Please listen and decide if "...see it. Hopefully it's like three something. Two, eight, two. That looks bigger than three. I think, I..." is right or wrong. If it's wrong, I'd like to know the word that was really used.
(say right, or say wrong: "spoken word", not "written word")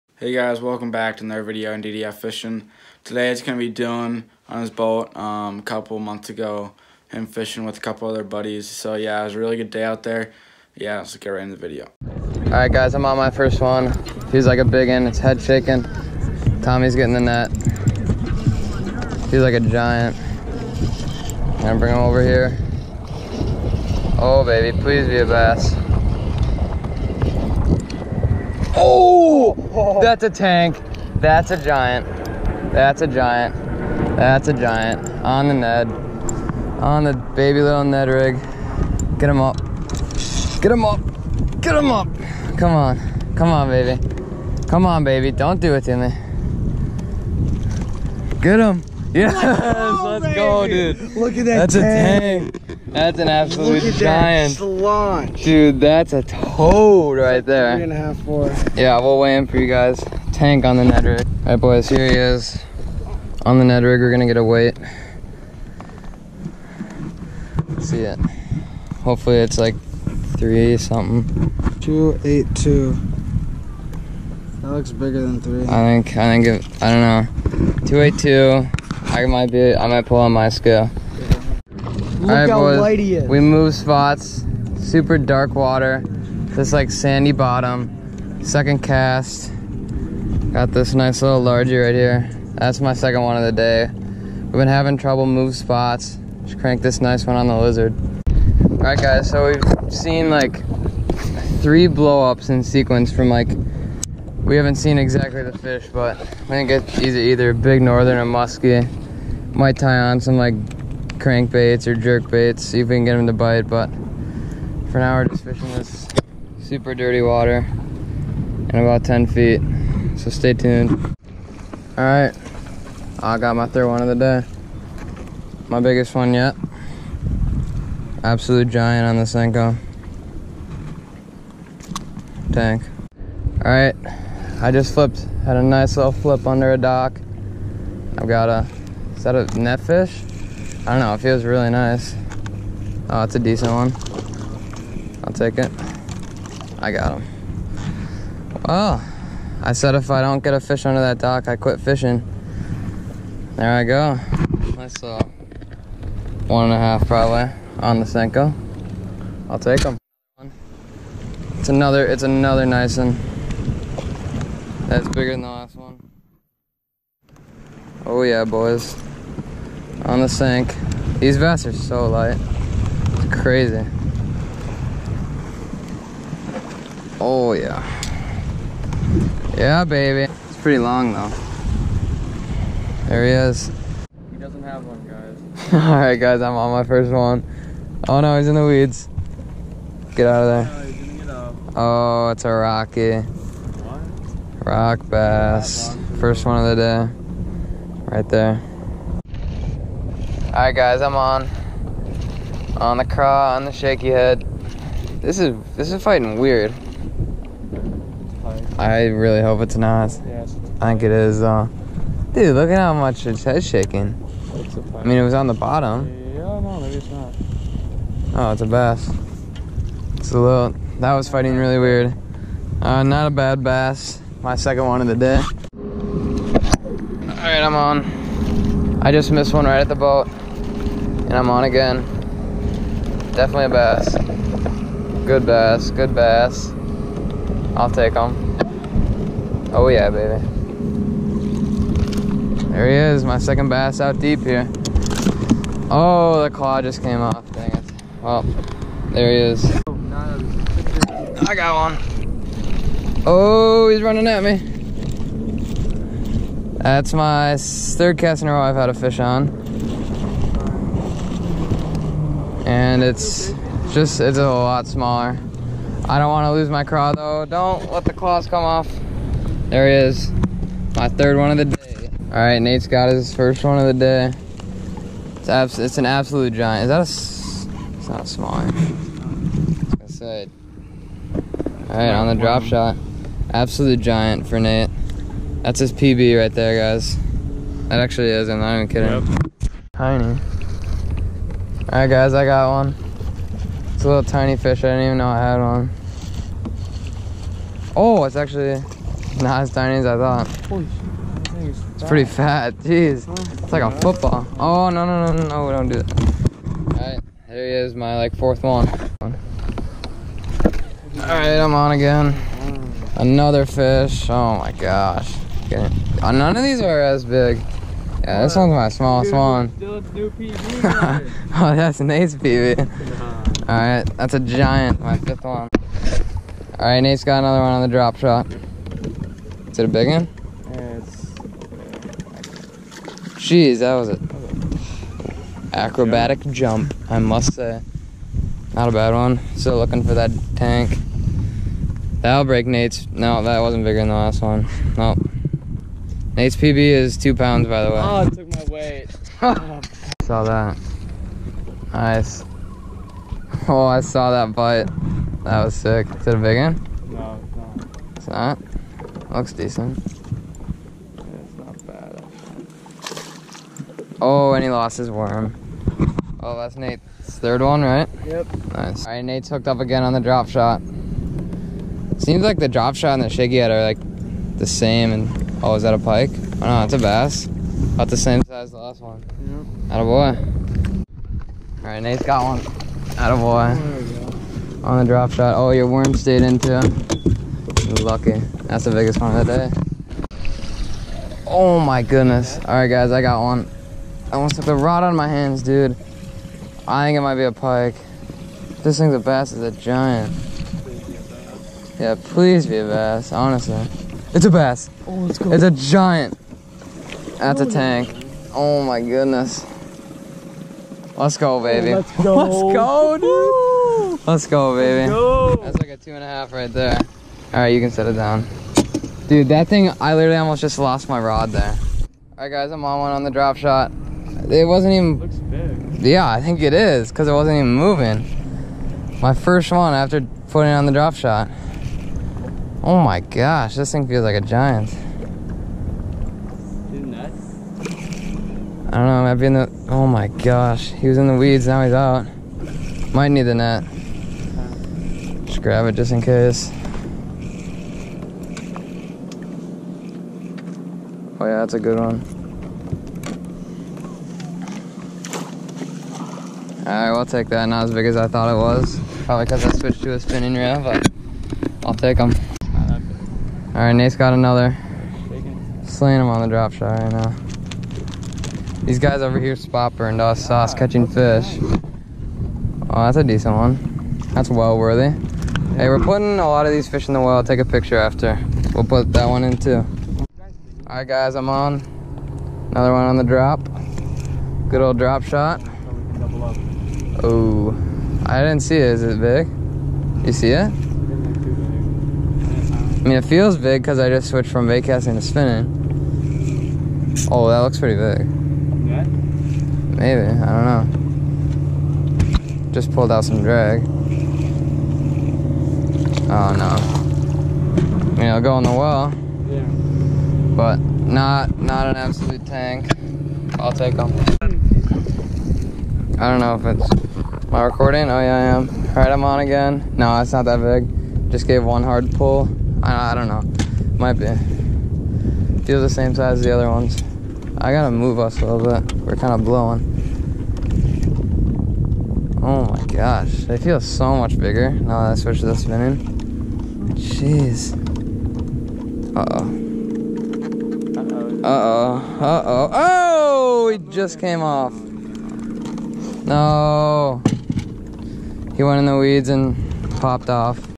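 right.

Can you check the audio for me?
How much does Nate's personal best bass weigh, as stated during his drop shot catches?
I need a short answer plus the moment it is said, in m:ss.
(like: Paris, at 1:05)
2 pounds, at 5:47.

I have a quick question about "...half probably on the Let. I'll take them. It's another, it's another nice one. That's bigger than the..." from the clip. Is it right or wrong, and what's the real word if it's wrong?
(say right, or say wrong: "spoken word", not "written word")
wrong: "Senko", not "Let".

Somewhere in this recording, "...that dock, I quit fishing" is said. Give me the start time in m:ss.
2:30.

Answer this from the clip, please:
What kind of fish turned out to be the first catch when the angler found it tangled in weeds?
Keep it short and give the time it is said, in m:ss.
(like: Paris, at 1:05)
rock bass, at 3:14.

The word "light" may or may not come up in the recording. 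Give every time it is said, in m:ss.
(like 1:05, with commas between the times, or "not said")
1:22, 2:52.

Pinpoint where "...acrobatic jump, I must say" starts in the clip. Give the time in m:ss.
5:35.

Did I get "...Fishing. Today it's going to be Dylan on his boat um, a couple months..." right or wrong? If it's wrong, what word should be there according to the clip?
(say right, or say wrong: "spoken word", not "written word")
right.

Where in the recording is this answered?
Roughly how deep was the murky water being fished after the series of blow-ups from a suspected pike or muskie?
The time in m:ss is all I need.
1:58.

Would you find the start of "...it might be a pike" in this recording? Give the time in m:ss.
6:37.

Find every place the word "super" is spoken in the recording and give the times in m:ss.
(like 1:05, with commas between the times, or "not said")
1:24, 1:56.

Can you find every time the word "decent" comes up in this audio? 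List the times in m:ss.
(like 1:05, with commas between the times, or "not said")
2:23, 5:59, 7:53.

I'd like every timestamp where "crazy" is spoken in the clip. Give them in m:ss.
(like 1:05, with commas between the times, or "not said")
2:53.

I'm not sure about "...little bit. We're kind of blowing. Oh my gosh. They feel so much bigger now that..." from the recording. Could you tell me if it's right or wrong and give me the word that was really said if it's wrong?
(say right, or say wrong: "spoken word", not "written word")
right.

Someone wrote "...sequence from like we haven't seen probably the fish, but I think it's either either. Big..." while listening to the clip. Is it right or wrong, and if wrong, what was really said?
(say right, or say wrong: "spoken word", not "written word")
wrong: "exactly", not "probably".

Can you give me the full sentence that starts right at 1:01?
All right, boys, here he is.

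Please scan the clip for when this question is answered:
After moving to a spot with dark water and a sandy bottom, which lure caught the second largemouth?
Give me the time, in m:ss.
1:37.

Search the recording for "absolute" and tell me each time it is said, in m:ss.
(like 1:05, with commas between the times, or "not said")
0:53, 2:08, 4:36, 4:43, 8:31.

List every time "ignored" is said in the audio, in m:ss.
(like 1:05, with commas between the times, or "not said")
not said.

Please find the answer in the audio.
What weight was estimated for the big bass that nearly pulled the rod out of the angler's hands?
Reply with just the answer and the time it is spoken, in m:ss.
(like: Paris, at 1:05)
2.5, at 6:55.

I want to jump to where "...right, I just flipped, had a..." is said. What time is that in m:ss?
2:13.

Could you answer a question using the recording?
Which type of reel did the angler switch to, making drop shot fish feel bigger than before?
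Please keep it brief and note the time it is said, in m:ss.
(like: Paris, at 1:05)
spinning reel, at 7:40.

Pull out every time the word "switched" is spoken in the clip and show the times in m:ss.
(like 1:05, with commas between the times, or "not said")
7:39, 8:14, 8:55.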